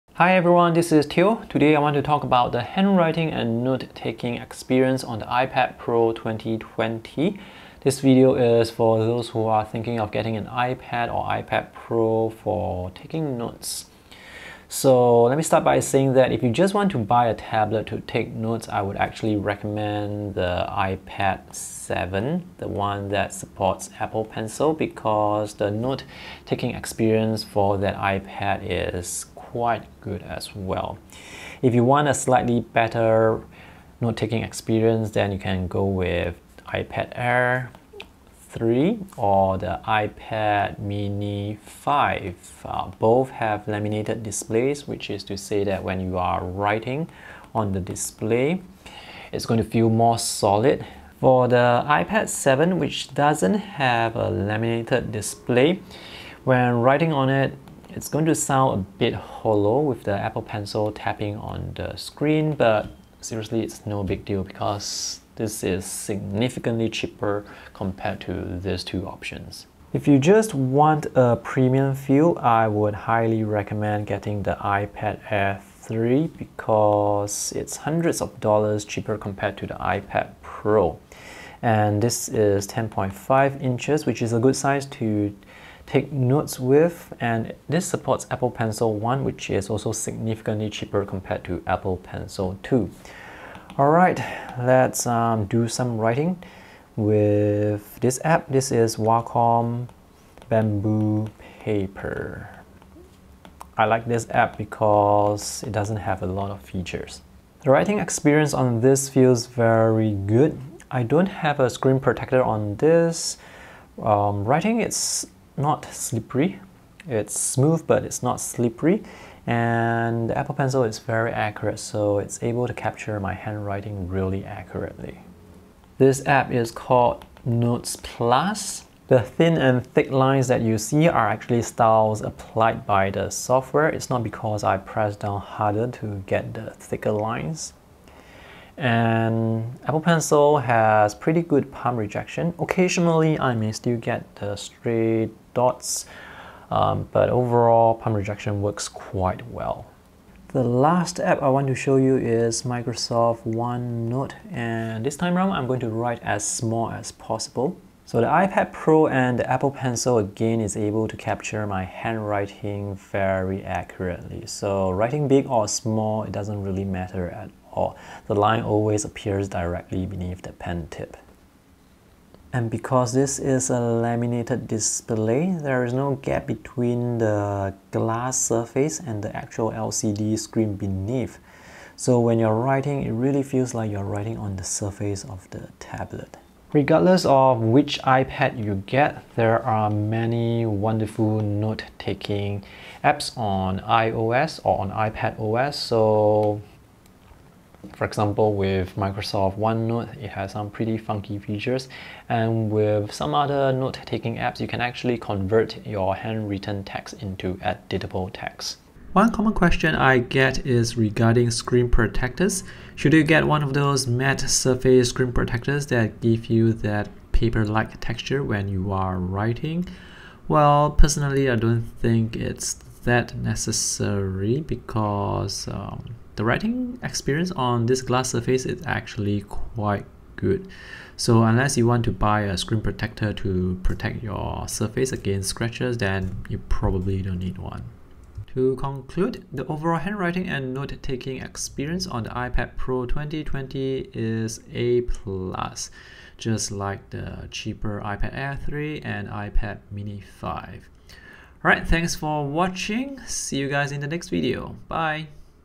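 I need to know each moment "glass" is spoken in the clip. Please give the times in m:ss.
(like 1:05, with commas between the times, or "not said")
2:57, 3:48.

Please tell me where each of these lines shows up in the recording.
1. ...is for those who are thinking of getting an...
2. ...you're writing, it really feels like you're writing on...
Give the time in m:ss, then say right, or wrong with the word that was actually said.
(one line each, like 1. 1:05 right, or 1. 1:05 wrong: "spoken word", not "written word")
1. 0:08 right
2. 3:02 right.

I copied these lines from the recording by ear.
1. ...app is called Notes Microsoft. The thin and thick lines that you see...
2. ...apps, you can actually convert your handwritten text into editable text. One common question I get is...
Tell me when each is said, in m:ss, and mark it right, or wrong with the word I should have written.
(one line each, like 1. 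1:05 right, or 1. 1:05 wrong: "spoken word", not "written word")
1. 2:06 wrong: "Plus", not "Microsoft"
2. 3:24 right.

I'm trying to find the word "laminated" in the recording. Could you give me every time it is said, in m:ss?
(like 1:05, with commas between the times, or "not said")
0:43, 0:54, 2:53.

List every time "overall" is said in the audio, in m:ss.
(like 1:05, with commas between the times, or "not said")
2:27, 3:59.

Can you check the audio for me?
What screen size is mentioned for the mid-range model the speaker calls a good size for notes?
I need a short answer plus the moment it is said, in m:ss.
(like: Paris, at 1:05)
10.5 inches, at 1:22.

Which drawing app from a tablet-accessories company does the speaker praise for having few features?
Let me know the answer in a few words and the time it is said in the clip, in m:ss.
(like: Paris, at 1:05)
Wacom Bamboo Paper, at 1:38.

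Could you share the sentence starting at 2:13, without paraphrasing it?
It's not because I press down harder to get the thicker lines.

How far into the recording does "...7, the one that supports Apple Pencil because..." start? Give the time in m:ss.
0:21.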